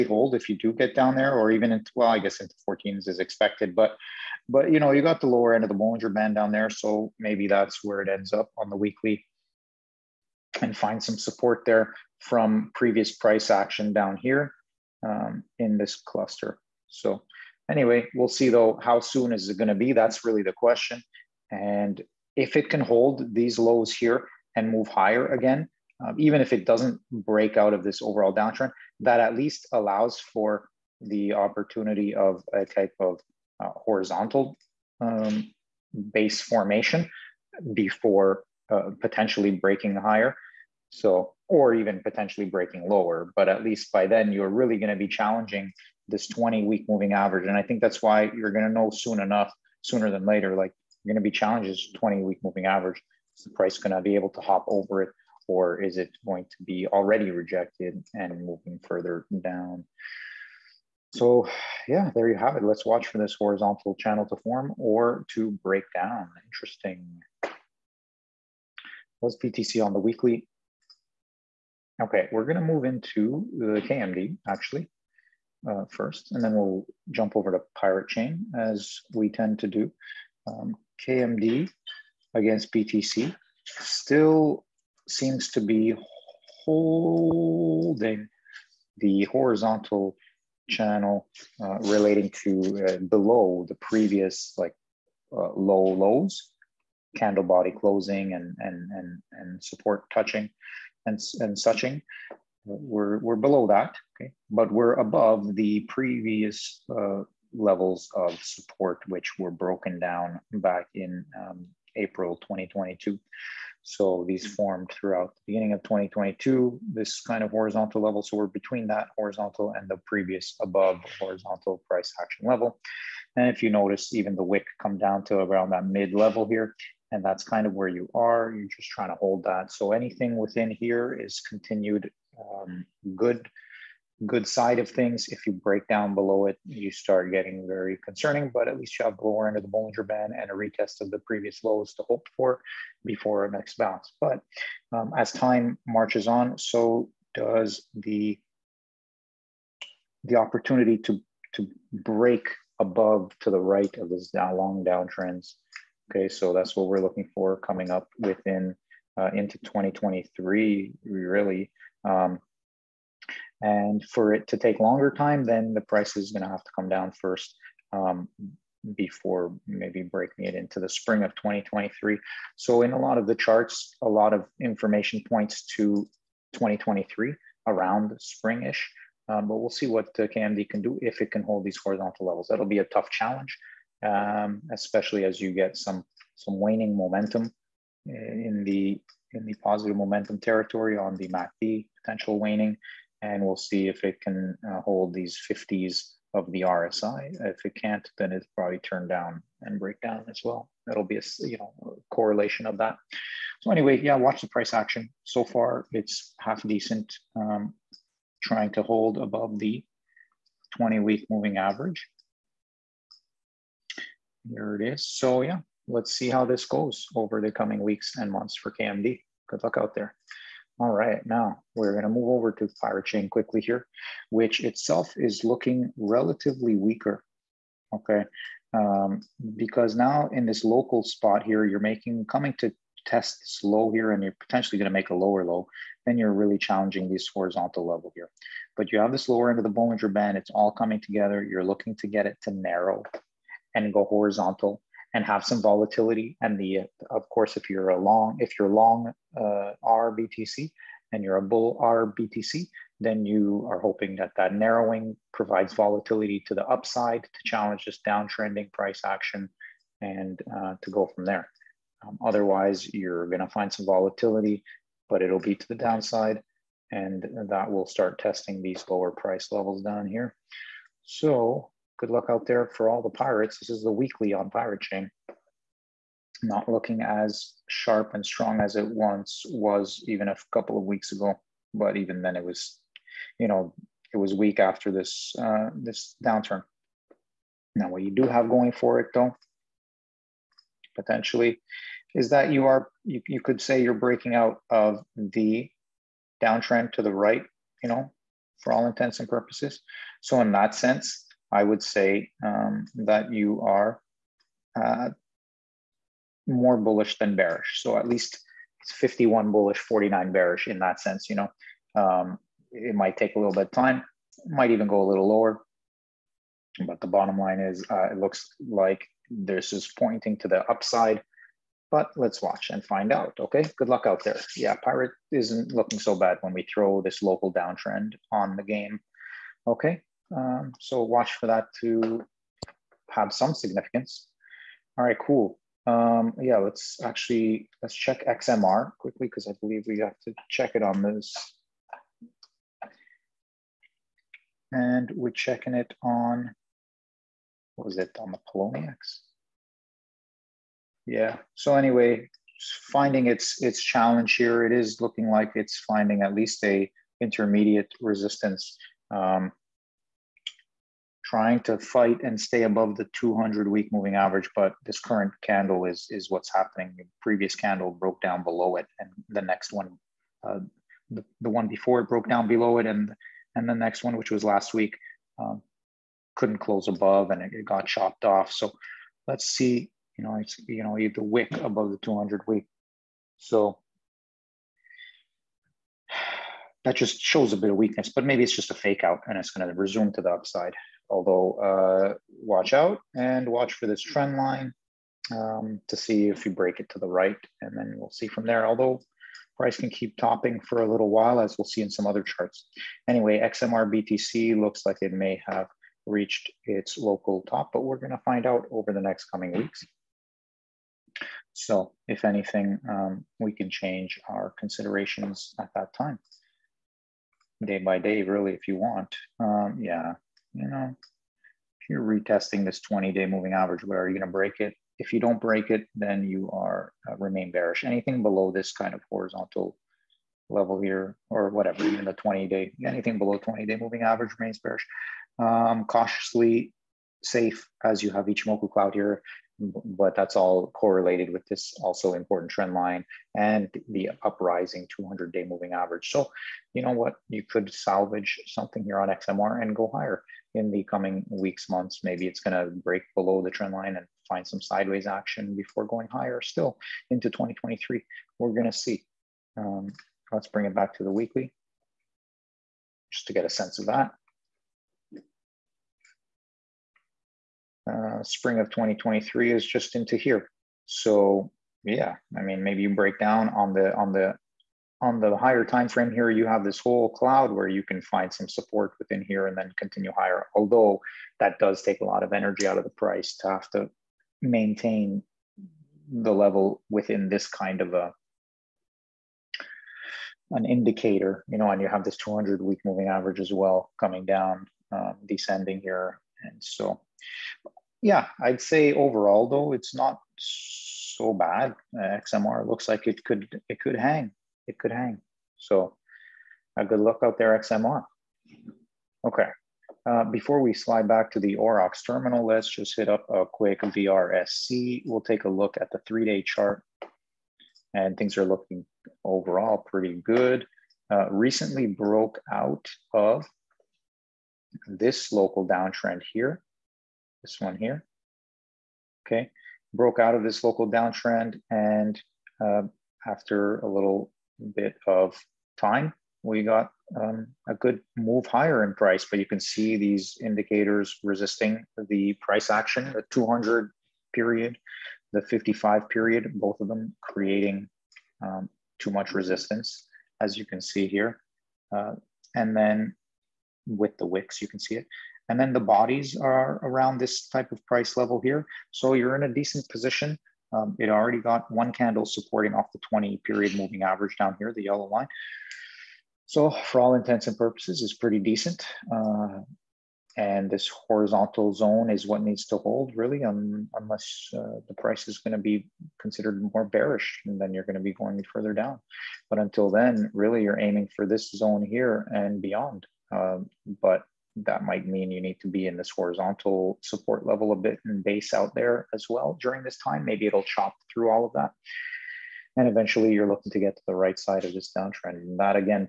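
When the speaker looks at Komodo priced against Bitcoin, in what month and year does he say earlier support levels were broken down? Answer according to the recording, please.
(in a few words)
April 2022.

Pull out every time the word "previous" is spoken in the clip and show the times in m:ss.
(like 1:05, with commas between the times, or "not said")
0:12, 1:33, 1:45, 2:00, 2:21, 6:07.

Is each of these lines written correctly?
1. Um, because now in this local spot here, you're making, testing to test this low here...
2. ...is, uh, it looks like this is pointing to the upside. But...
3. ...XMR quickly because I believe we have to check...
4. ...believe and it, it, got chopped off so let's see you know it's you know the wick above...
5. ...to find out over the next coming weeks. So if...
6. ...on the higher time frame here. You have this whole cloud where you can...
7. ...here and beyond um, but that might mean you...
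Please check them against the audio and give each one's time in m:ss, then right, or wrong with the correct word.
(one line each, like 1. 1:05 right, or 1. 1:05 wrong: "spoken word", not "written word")
1. 3:48 wrong: "coming", not "testing"
2. 5:17 right
3. 5:38 right
4. 6:16 wrong: "above", not "believe"
5. 6:48 right
6. 7:54 right
7. 9:41 right.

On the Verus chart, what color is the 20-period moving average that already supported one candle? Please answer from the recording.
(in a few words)
Yellow.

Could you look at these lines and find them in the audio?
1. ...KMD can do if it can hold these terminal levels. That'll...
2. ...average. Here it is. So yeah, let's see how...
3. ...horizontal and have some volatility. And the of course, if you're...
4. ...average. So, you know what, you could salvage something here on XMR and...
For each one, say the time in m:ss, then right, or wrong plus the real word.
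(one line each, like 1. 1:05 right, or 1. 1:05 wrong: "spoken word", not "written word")
1. 3:00 wrong: "horizontal", not "terminal"
2. 3:31 right
3. 4:04 right
4. 7:25 right.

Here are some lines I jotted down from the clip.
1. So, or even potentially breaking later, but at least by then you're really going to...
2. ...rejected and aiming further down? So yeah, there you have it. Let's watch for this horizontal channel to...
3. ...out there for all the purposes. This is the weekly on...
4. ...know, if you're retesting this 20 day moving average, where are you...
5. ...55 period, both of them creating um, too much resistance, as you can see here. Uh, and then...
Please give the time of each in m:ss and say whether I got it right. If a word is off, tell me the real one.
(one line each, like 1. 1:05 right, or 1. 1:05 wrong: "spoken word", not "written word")
1. 0:40 wrong: "lower", not "later"
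2. 0:57 wrong: "moving", not "aiming"
3. 4:32 wrong: "pirates", not "purposes"
4. 7:00 right
5. 9:05 right.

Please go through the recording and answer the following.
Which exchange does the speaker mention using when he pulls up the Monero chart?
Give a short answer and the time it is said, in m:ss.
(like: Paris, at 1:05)
Poloniex, at 5:48.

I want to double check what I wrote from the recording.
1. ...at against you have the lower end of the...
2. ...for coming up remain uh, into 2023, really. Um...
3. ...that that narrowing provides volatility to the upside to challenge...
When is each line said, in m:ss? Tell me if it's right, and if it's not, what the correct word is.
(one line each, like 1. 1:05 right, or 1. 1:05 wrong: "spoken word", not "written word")
1. 2:18 wrong: "least", not "against"
2. 2:37 wrong: "within", not "remain"
3. 4:14 right.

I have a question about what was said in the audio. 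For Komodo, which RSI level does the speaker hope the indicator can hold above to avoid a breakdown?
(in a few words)
50.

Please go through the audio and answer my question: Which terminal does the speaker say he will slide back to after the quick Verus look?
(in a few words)
Orox terminal.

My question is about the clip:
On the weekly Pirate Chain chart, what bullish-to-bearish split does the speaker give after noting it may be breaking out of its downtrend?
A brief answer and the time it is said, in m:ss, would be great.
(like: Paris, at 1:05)
51 bullish, 49 bearish, at 5:08.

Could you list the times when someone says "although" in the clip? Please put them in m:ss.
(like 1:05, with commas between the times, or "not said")
6:31, 6:38, 8:00.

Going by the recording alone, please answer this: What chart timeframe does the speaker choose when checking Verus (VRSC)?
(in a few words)
Three-day.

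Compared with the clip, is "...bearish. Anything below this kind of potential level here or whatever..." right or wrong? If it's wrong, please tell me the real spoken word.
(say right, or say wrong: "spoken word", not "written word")
wrong: "horizontal", not "potential".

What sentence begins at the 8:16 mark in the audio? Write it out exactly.
And so yeah, I'd say overall though it's not so bad.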